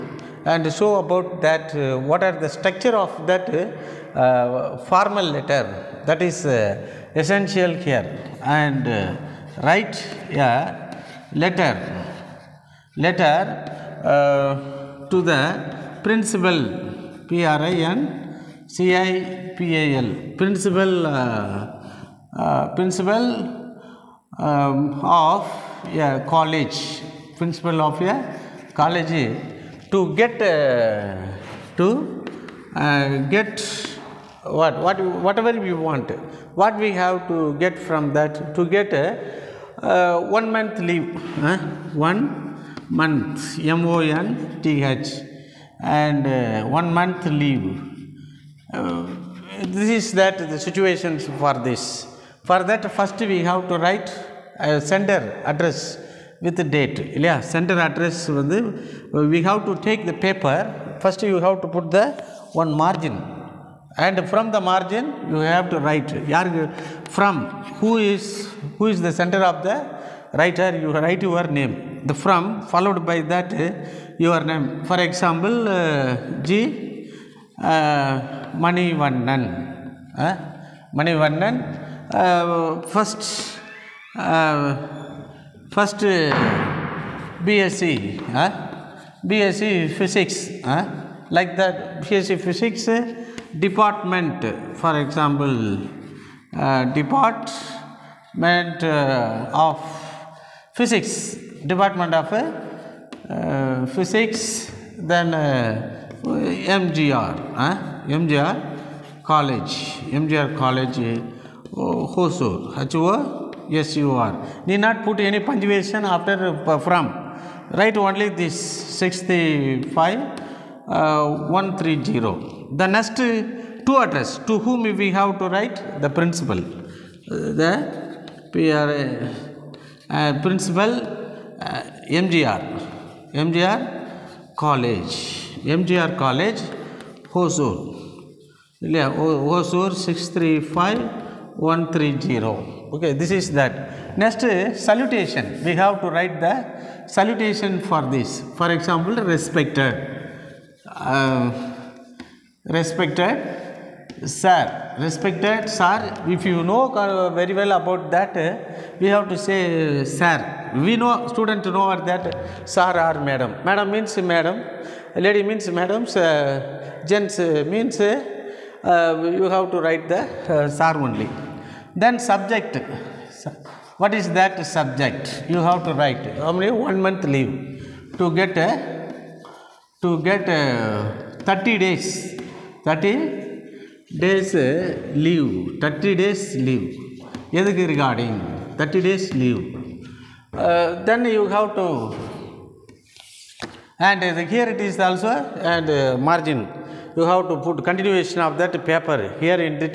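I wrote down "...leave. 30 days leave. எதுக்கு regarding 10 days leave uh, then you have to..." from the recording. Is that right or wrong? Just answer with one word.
wrong.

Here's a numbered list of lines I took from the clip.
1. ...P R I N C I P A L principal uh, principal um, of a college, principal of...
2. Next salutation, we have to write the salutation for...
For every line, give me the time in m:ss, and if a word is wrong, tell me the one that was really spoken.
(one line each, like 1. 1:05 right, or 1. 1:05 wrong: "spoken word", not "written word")
1. 0:17 right
2. 2:24 right.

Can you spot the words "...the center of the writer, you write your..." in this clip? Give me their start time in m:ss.
1:09.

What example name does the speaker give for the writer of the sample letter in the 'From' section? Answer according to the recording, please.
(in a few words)
Mani Vannan.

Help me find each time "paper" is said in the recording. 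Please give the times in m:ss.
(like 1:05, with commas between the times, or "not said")
1:00, 3:18.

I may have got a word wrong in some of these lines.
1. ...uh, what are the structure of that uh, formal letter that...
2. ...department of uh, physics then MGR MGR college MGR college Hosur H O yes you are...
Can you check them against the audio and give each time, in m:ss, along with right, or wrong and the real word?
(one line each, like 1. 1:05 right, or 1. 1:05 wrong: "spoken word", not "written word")
1. 0:01 right
2. 1:41 right.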